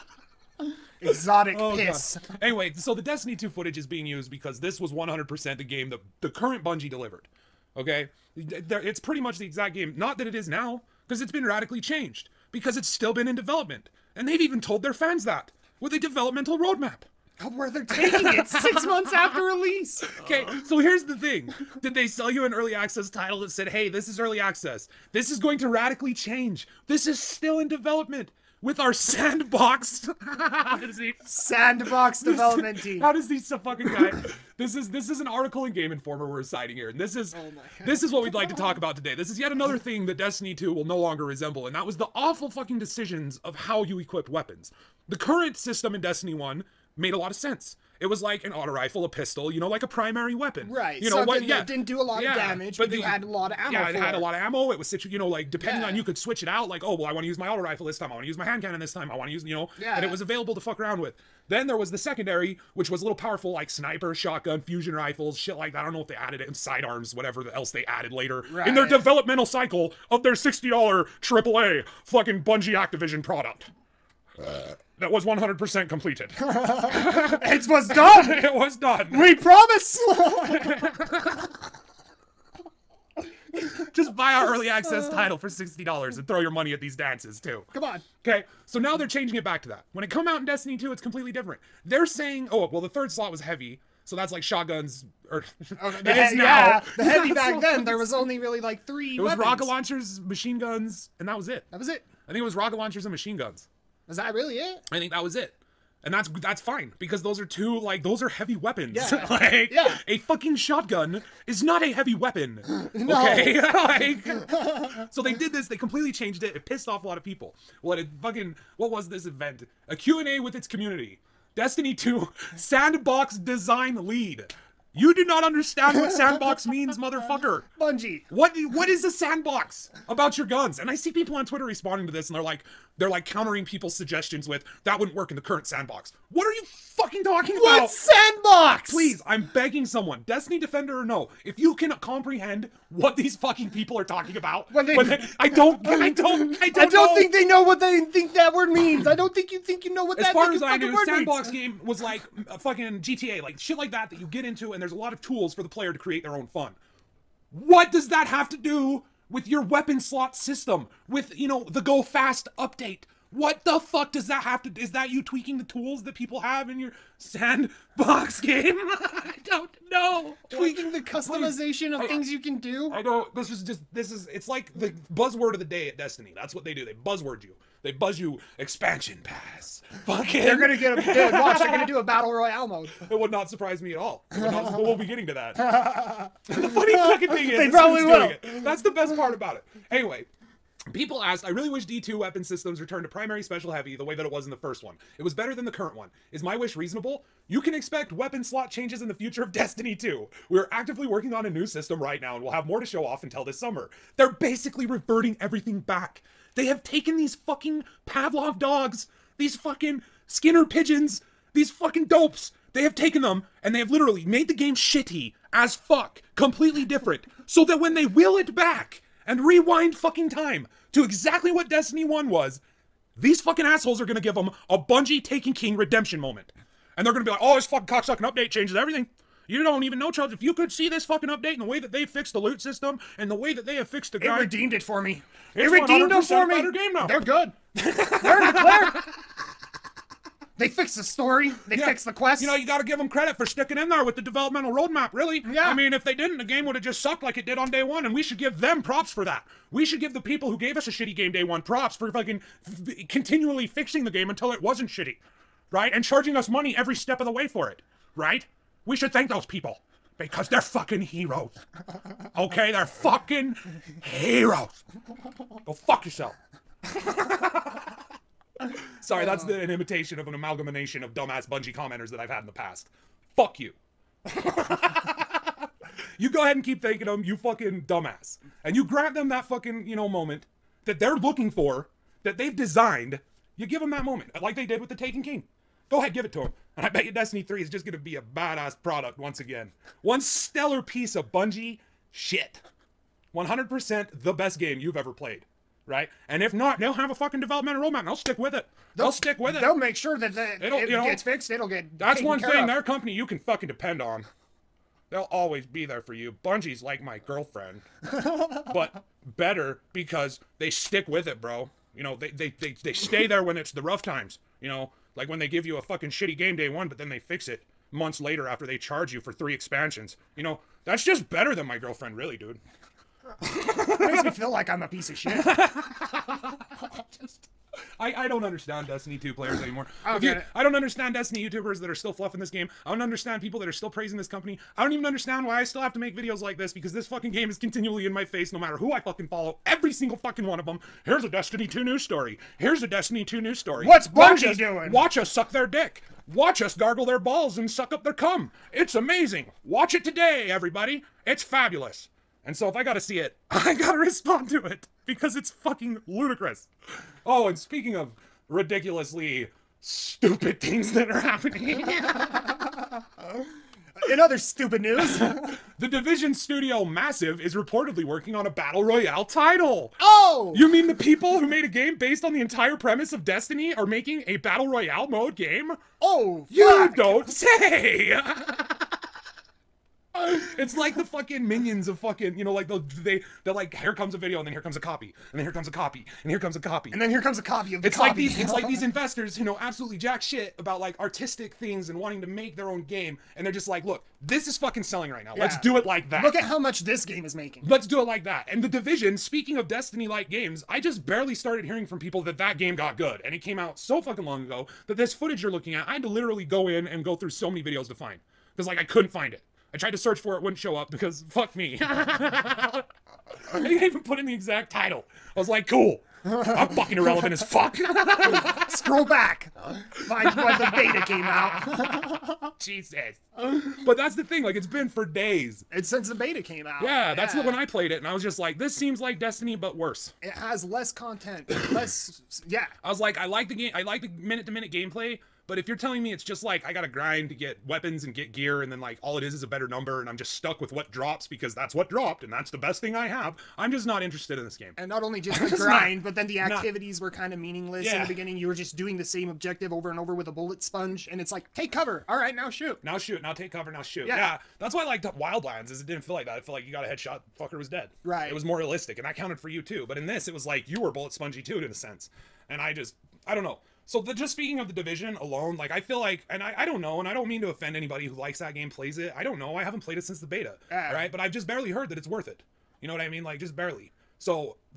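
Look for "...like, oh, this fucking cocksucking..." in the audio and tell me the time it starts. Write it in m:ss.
3:47.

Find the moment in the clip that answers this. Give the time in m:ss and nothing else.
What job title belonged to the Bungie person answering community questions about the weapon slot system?
2:02.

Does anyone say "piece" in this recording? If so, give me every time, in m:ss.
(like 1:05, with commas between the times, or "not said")
4:50, 5:24.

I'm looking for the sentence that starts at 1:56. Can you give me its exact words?
It pissed off a lot of people.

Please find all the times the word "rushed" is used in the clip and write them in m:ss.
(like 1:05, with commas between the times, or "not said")
not said.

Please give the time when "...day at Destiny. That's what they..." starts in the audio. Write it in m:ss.
2:55.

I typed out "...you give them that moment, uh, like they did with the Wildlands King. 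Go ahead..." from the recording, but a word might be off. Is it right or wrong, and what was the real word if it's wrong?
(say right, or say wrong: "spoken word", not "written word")
wrong: "Taken", not "Wildlands".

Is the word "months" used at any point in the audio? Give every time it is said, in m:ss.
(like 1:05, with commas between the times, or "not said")
0:18, 5:17.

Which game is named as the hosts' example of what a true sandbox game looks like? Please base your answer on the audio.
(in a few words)
GTA.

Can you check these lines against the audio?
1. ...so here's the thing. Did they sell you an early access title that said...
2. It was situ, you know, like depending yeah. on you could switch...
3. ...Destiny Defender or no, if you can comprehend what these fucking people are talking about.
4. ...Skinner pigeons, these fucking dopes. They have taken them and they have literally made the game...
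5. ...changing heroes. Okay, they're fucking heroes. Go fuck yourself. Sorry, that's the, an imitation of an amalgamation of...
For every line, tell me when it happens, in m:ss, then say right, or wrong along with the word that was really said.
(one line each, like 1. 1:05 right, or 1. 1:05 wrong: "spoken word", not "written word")
1. 0:20 right
2. 0:54 right
3. 2:20 right
4. 3:30 right
5. 4:20 wrong: "fucking", not "changing".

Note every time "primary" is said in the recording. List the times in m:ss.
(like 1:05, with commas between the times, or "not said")
0:49, 3:13.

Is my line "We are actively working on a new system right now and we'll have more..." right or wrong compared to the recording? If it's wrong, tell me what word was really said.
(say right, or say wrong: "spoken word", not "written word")
right.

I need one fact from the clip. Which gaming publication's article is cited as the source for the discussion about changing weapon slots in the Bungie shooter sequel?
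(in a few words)
Game Informer.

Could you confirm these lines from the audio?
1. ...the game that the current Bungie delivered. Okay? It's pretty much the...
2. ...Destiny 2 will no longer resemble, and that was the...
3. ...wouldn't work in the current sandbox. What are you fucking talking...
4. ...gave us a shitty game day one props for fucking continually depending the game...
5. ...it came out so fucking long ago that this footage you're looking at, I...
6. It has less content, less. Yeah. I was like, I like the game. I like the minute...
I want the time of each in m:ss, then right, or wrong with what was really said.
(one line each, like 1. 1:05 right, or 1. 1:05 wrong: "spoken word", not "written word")
1. 0:05 right
2. 0:40 right
3. 2:14 right
4. 4:10 wrong: "fixing", not "depending"
5. 6:43 right
6. 7:10 right.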